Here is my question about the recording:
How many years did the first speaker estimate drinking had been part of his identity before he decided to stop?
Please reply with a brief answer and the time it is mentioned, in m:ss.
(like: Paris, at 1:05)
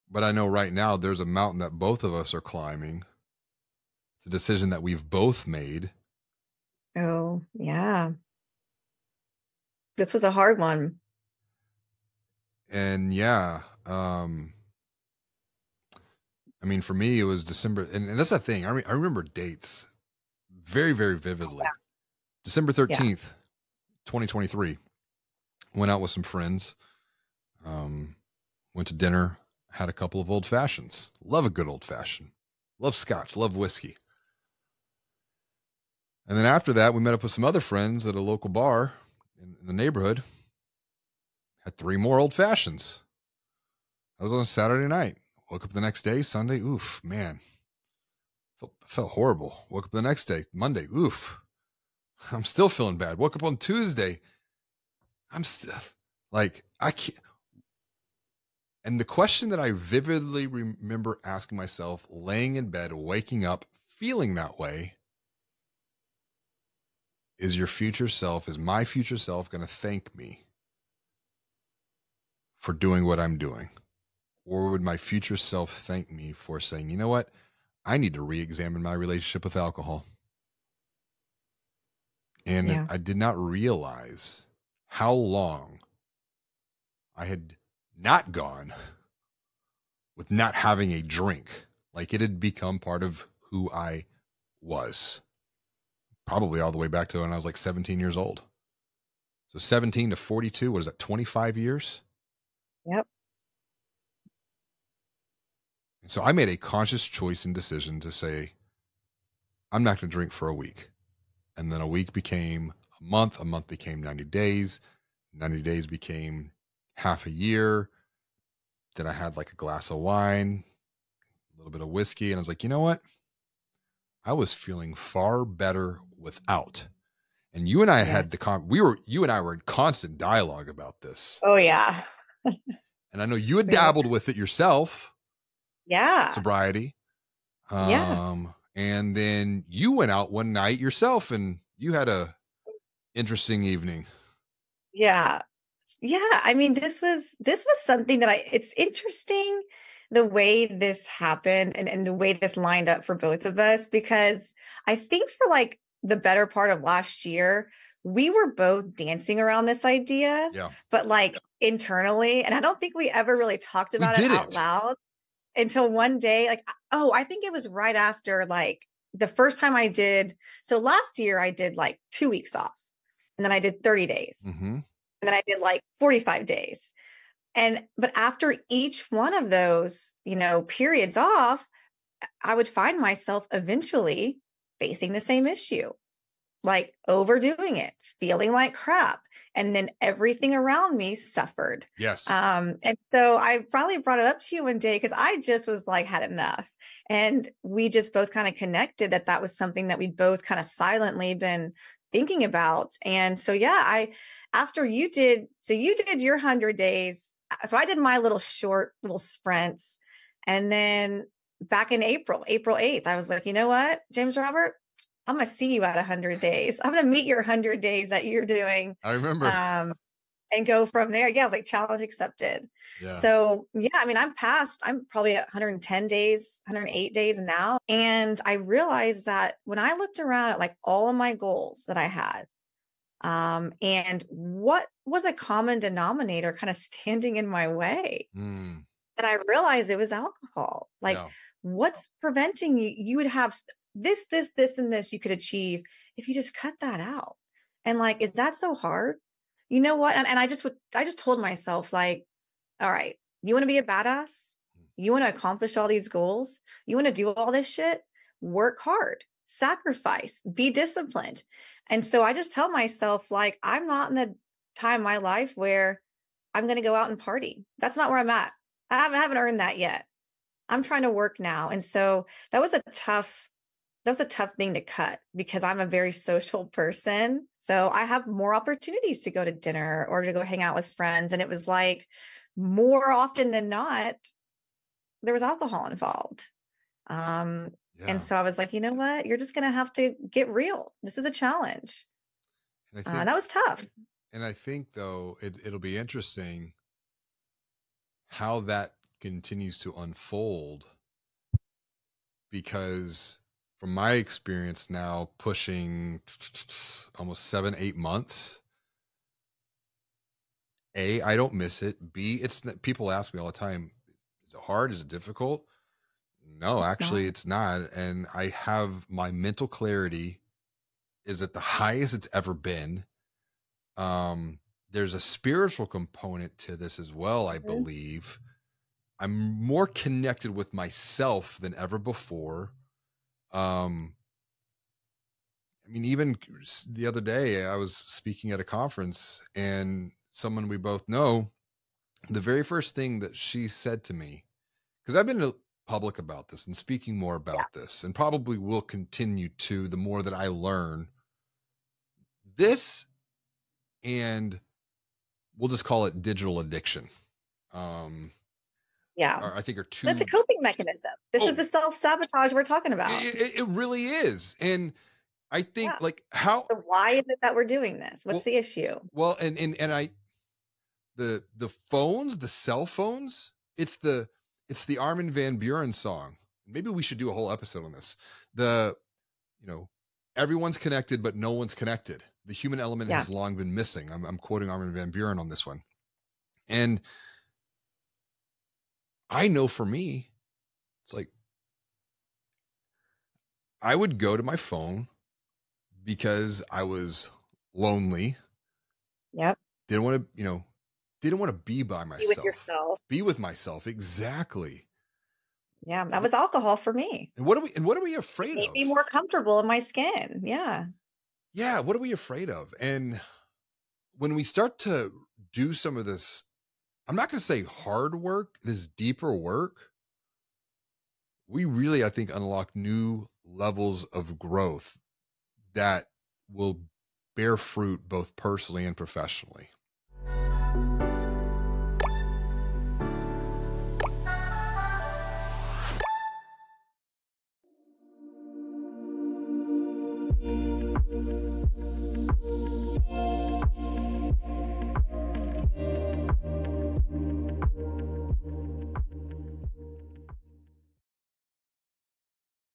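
25 years, at 1:40.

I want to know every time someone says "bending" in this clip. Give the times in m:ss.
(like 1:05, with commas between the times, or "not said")
not said.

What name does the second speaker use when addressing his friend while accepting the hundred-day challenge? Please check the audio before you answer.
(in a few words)
James Robert.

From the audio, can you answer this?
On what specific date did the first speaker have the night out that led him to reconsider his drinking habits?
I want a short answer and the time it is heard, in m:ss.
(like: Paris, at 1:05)
December 13th, at 0:22.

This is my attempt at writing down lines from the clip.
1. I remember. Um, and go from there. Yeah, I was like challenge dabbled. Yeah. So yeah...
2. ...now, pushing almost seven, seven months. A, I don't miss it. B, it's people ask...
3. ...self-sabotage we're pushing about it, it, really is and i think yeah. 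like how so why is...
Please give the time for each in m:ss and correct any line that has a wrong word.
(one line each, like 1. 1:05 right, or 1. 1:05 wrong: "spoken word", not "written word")
1. 3:39 wrong: "accepted", not "dabbled"
2. 5:04 wrong: "eight", not "seven"
3. 6:01 wrong: "talking", not "pushing".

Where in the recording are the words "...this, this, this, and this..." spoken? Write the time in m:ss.
4:03.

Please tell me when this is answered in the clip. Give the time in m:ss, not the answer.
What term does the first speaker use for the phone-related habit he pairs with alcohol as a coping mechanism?
5:56.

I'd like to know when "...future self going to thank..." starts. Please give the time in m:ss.
1:08.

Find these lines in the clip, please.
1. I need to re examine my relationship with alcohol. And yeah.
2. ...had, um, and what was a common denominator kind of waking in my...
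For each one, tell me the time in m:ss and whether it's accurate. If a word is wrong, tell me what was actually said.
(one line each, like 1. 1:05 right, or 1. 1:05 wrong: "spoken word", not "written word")
1. 1:17 right
2. 3:52 wrong: "standing", not "waking".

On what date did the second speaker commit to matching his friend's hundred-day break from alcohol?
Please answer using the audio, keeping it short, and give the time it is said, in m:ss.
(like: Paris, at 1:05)
April 8th, at 3:32.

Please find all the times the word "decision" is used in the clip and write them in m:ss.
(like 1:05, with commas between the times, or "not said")
0:04, 1:47.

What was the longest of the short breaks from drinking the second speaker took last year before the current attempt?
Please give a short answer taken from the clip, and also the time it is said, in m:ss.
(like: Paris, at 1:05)
45 days, at 2:55.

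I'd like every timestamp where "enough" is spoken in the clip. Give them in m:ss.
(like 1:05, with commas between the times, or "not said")
3:16.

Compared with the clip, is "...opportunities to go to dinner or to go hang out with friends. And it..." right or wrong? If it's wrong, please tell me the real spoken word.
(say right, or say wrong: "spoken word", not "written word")
right.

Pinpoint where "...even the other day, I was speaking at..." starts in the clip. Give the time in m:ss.
5:36.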